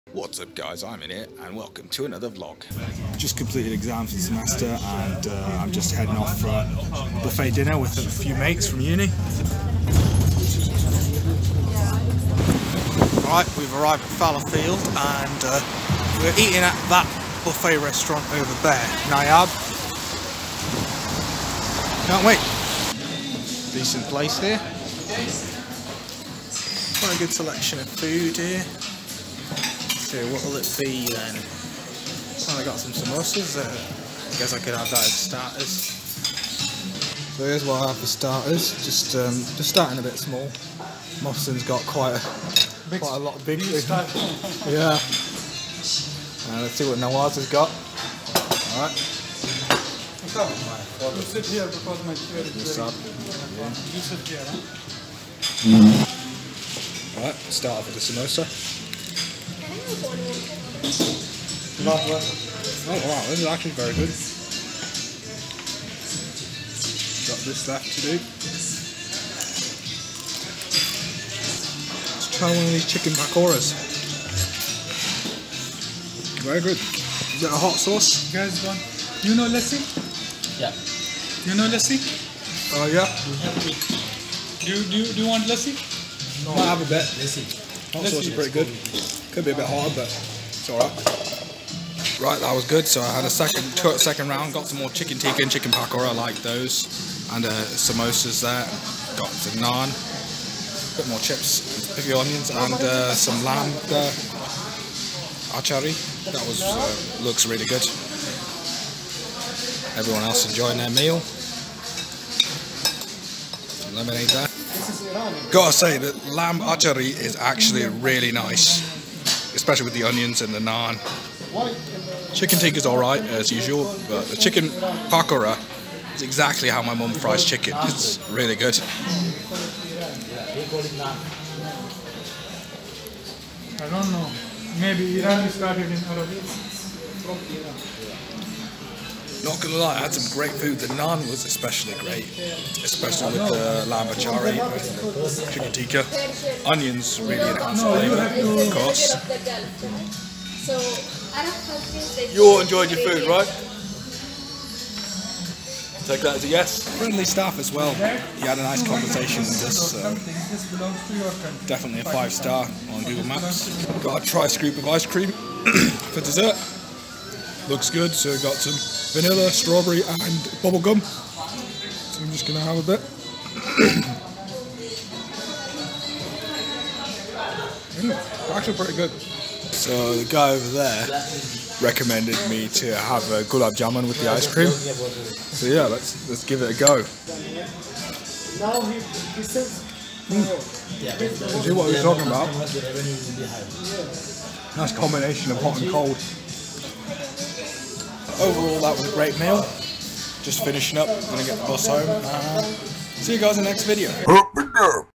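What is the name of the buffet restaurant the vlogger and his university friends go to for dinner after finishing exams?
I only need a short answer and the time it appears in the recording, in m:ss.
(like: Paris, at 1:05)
Nayaab, at 0:19.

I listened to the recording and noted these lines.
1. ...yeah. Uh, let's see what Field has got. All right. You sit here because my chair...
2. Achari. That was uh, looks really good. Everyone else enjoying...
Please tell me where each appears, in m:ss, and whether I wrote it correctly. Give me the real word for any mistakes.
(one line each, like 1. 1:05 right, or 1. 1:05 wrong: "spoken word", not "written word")
1. 0:43 wrong: "Nawaz", not "Field"
2. 1:45 right.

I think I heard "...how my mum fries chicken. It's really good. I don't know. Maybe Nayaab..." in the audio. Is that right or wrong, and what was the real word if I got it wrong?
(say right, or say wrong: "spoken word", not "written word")
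wrong: "Iran", not "Nayaab".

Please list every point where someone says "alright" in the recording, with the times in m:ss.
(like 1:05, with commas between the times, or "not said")
0:57, 2:02.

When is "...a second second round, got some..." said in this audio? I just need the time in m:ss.
1:33.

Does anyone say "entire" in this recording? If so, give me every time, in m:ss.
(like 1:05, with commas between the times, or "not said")
not said.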